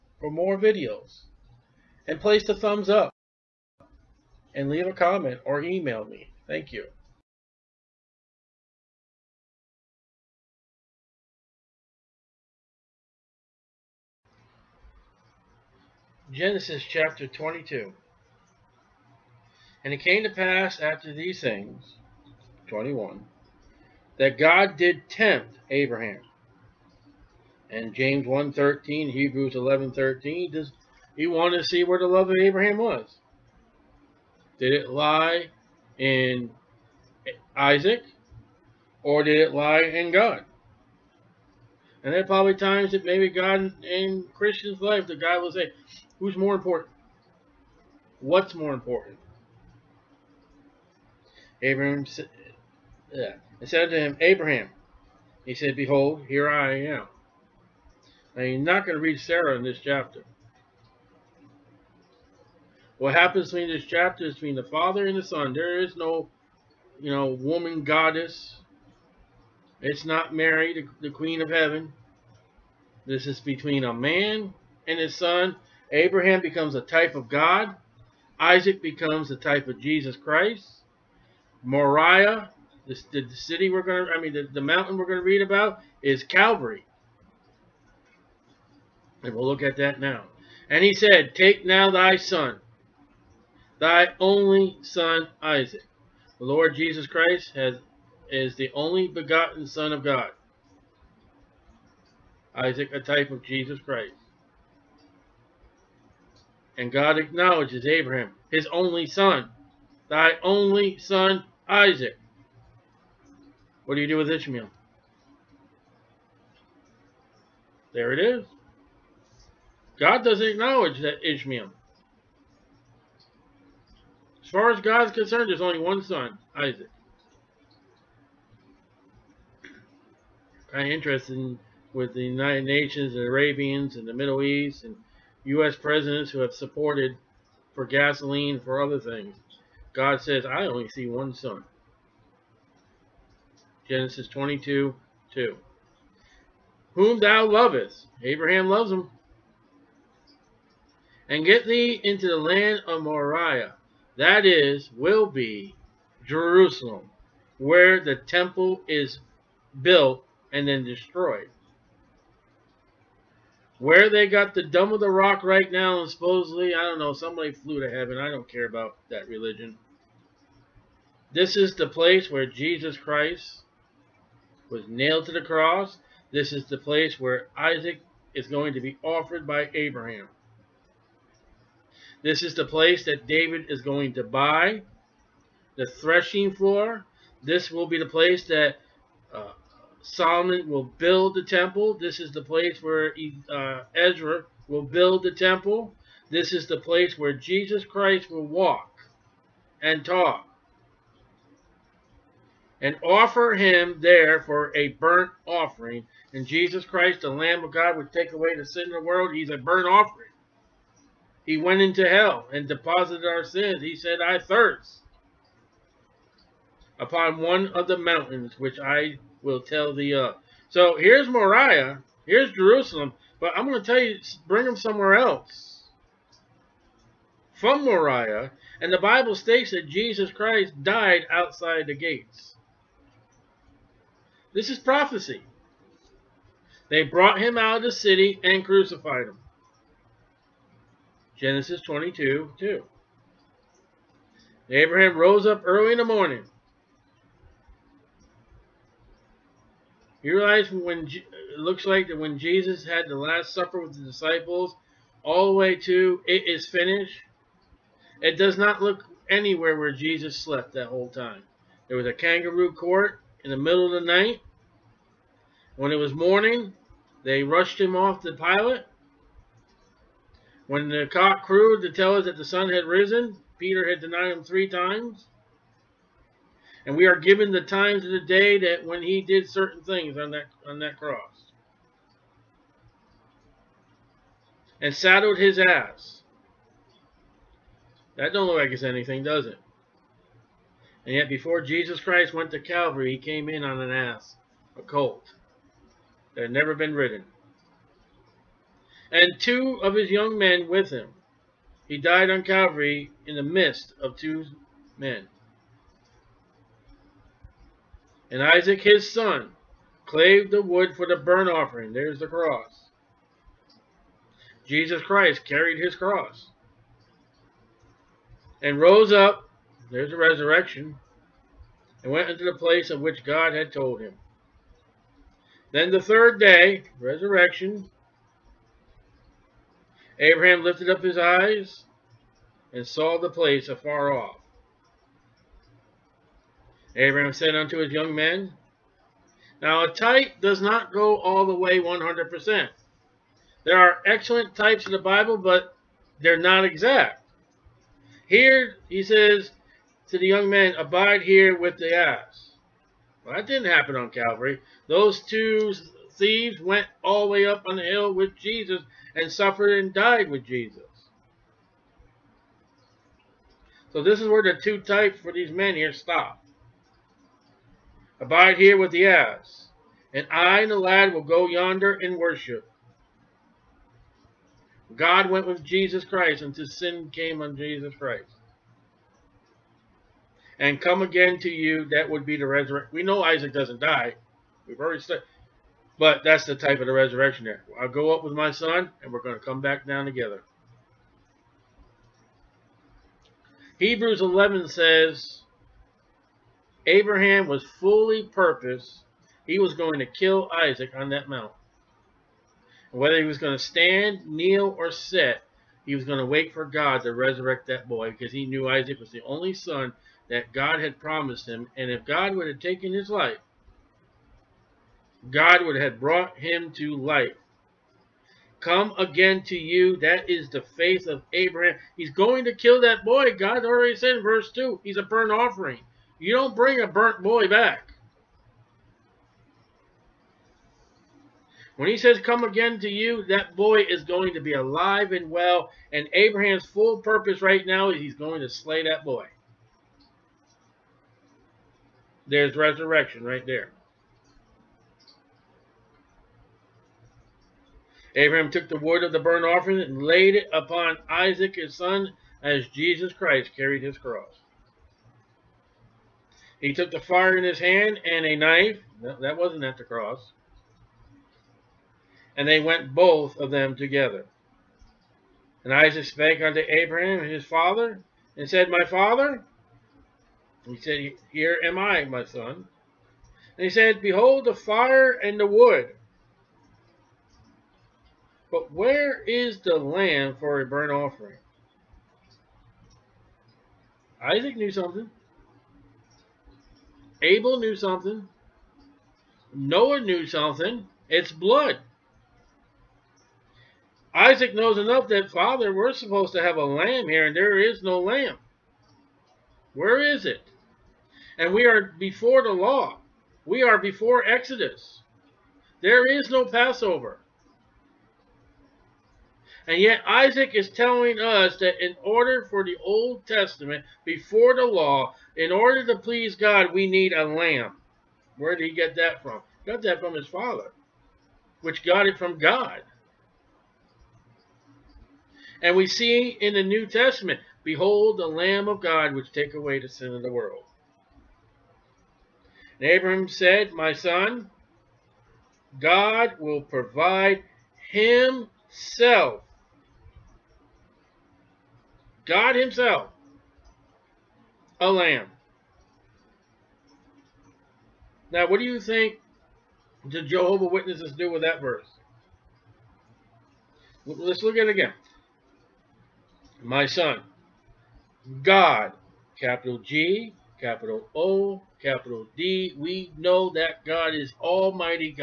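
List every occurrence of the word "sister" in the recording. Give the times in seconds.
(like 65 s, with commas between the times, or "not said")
not said.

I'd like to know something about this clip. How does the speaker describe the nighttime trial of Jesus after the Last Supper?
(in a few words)
a kangaroo court.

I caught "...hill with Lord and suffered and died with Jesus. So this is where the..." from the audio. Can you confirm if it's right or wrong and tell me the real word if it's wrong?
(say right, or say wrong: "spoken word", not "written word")
wrong: "Jesus", not "Lord".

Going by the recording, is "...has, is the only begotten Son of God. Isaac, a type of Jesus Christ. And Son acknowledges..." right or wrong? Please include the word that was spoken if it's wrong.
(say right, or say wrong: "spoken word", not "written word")
wrong: "God", not "Son".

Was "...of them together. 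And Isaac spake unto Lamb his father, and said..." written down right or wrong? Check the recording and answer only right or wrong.
wrong.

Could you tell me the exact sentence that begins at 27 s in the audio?
And James 1.13, Hebrews 11.13, does he wanted to see where the love of Abraham was.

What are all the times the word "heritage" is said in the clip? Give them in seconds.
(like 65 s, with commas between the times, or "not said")
not said.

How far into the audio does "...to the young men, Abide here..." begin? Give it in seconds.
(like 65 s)
350 s.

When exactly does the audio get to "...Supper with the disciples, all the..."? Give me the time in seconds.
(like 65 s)
253 s.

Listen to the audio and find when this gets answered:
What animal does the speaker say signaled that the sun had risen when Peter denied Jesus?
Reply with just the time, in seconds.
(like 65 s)
271 s.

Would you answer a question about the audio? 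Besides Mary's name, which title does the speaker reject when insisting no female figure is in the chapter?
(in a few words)
Queen of Heaven.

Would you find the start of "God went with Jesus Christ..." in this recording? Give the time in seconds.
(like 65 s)
374 s.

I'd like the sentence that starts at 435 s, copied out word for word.
And Abraham's full purpose right now is he's going to slay that boy.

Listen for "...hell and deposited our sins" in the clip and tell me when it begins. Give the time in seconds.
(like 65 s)
212 s.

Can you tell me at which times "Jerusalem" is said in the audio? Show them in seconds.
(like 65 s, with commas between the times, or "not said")
156 s, 222 s.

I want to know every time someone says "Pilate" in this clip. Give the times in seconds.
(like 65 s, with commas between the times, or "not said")
268 s.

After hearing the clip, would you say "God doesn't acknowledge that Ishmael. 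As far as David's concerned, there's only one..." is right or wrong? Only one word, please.
wrong.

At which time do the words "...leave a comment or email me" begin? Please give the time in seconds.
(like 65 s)
4 s.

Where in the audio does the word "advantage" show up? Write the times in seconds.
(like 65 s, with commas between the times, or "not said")
not said.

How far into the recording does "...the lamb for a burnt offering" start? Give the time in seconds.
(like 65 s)
479 s.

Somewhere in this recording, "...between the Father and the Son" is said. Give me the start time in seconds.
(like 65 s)
64 s.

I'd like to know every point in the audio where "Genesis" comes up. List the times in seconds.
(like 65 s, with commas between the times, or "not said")
16 s, 143 s, 241 s.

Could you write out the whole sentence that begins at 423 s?
God already said in verse 2, he's a burnt offering.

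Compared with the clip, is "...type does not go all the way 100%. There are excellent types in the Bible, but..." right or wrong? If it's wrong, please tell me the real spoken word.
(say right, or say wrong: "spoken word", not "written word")
right.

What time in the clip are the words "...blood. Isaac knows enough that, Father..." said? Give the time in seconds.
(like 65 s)
491 s.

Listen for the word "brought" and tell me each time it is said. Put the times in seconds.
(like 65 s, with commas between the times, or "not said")
237 s, 415 s.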